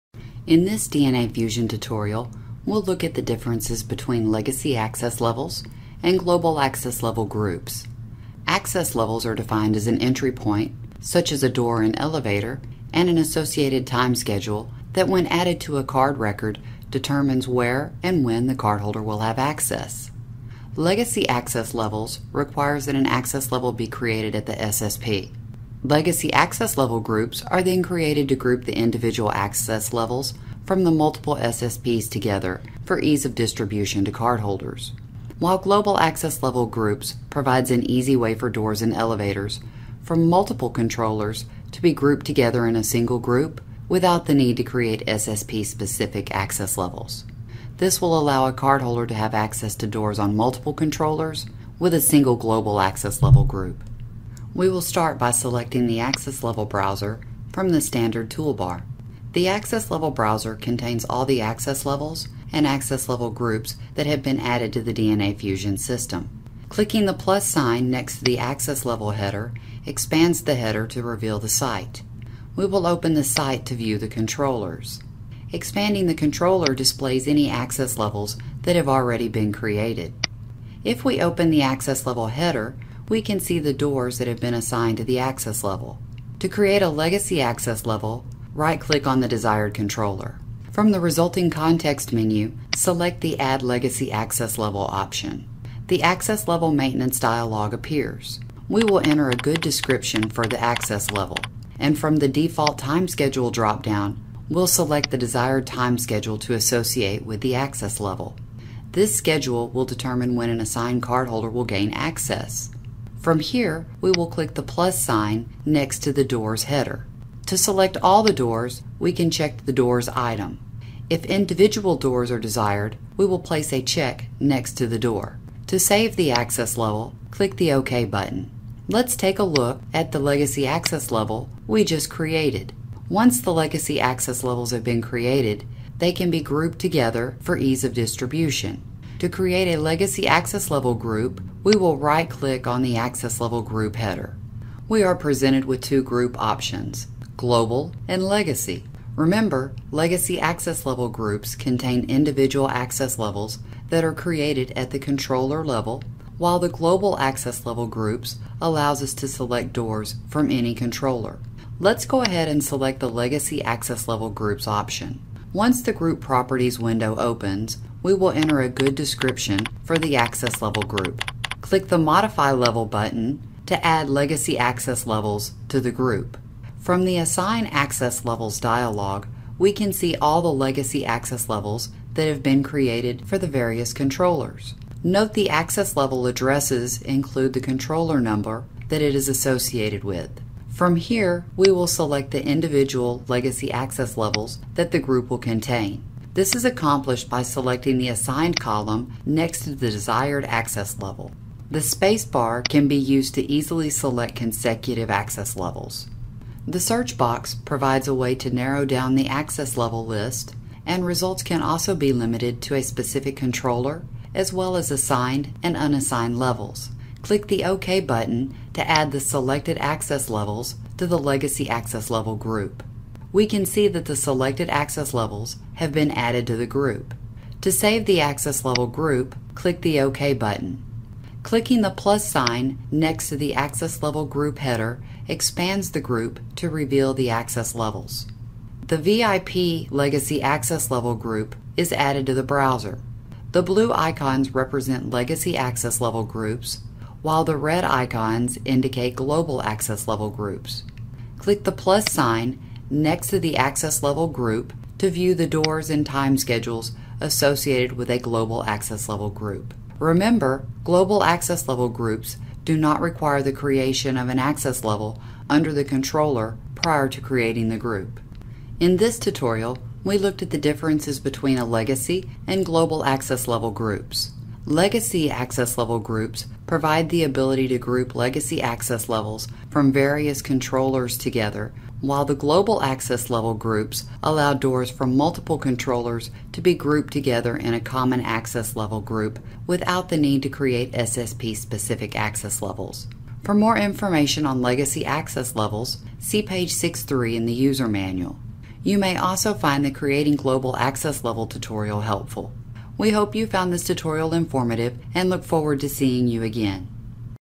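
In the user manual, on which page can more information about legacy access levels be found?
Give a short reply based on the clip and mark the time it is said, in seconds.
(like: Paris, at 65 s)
63, at 296 s.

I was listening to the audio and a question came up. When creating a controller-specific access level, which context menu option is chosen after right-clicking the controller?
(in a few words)
Add Legacy Access Level.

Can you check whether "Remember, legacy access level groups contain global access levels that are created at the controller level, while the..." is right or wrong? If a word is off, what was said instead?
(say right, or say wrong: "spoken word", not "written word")
wrong: "individual", not "global".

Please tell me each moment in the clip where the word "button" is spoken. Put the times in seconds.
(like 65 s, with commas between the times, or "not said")
128 s, 172 s, 217 s, 230 s.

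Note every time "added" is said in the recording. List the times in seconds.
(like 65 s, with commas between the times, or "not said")
15 s, 64 s, 226 s, 241 s.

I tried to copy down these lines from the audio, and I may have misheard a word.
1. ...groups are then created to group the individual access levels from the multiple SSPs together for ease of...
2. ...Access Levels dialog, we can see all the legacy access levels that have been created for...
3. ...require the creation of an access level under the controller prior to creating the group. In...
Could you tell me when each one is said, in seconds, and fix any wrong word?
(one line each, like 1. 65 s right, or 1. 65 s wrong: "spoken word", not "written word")
1. 26 s right
2. 177 s right
3. 262 s right.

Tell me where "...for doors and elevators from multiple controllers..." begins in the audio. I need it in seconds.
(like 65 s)
38 s.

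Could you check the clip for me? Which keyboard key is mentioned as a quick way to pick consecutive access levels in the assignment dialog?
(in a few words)
space bar.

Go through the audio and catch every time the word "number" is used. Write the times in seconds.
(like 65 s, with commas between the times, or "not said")
188 s.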